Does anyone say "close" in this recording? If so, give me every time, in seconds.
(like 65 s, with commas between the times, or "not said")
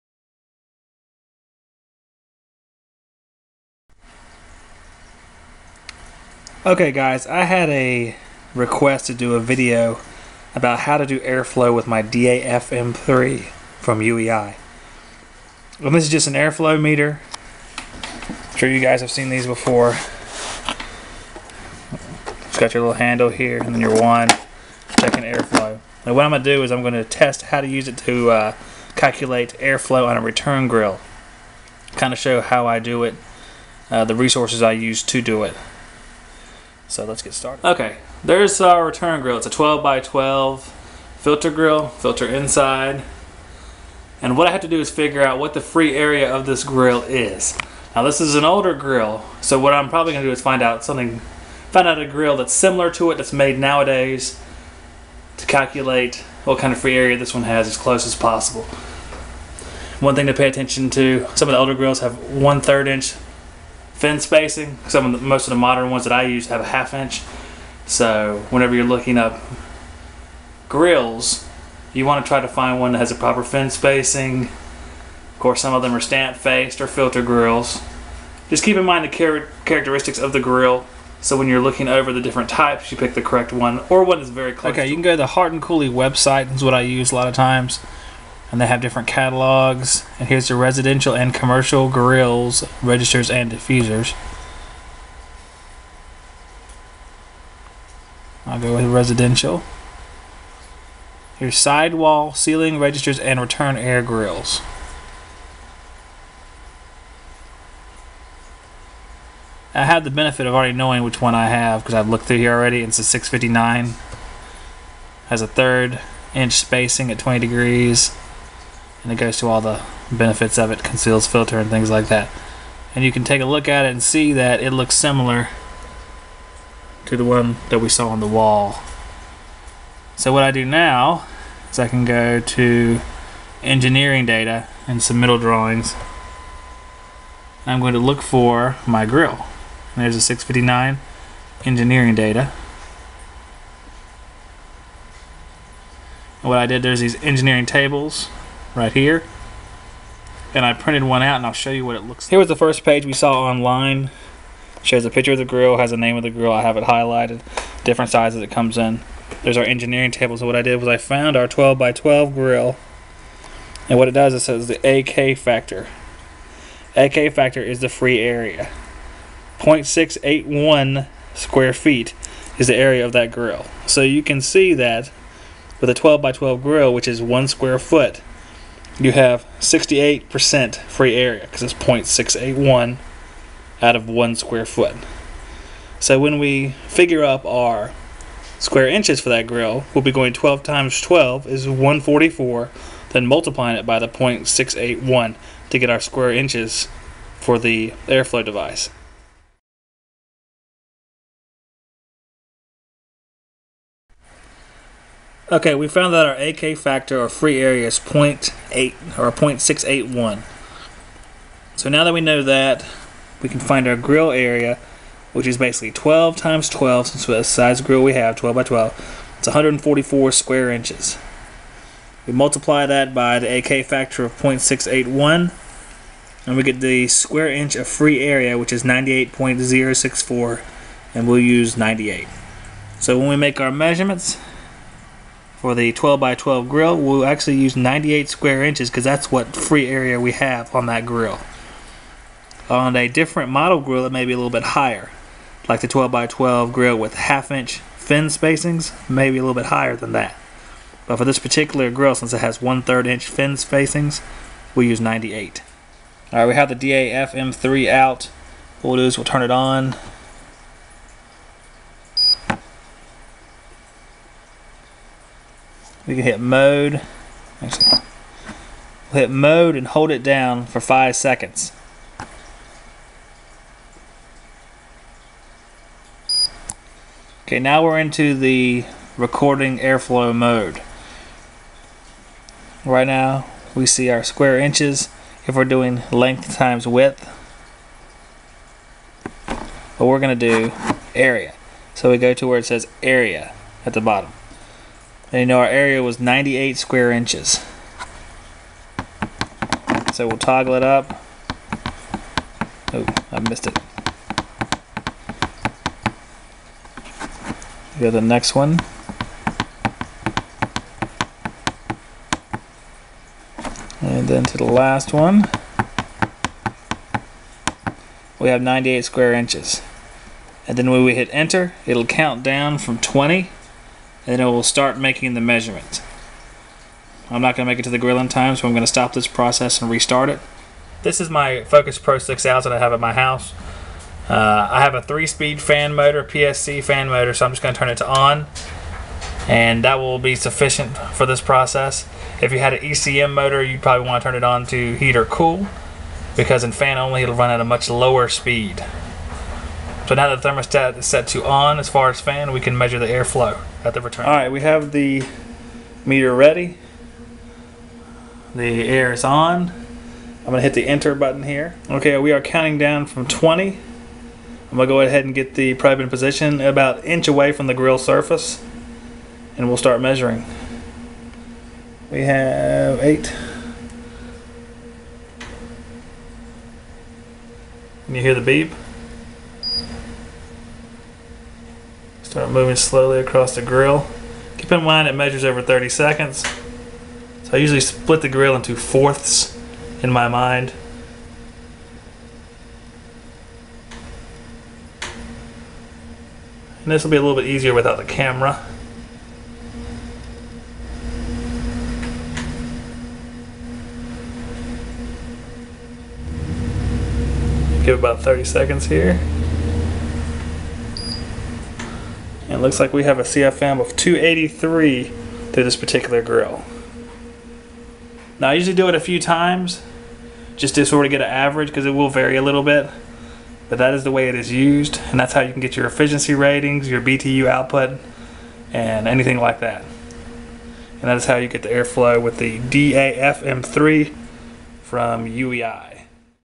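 57 s, 84 s.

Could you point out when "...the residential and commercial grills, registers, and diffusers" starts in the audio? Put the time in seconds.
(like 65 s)
90 s.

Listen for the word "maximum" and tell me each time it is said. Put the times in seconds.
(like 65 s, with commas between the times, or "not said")
not said.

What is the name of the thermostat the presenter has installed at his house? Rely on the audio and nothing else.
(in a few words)
Focus Pro 6000.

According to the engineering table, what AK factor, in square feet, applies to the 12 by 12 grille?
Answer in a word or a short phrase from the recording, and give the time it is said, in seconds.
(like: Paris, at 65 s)
0.681, at 169 s.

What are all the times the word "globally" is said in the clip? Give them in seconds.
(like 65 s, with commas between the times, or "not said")
not said.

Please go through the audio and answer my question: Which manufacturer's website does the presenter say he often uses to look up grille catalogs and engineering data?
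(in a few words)
Hart and Cooley.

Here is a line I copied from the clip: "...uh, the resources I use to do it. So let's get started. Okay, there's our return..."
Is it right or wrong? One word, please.
right.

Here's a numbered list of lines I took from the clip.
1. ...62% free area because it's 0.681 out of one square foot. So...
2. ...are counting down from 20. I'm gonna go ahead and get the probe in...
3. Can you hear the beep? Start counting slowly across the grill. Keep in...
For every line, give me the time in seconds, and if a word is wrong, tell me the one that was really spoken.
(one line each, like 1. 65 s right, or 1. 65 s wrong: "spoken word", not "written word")
1. 179 s wrong: "68", not "62"
2. 362 s right
3. 378 s wrong: "moving", not "counting".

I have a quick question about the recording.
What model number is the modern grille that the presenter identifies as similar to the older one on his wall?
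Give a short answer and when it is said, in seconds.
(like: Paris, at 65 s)
659, at 112 s.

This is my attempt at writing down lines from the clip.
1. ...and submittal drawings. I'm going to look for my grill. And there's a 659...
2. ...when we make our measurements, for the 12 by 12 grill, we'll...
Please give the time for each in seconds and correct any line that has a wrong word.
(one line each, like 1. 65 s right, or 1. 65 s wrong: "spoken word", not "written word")
1. 134 s right
2. 233 s right.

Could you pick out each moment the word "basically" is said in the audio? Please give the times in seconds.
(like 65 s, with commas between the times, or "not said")
215 s.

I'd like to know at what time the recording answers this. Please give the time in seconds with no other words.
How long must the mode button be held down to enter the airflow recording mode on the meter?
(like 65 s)
270 s.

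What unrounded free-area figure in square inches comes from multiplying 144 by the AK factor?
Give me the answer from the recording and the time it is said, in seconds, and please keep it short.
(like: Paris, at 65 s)
98.064, at 228 s.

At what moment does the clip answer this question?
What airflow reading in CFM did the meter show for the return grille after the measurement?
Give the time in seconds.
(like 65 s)
413 s.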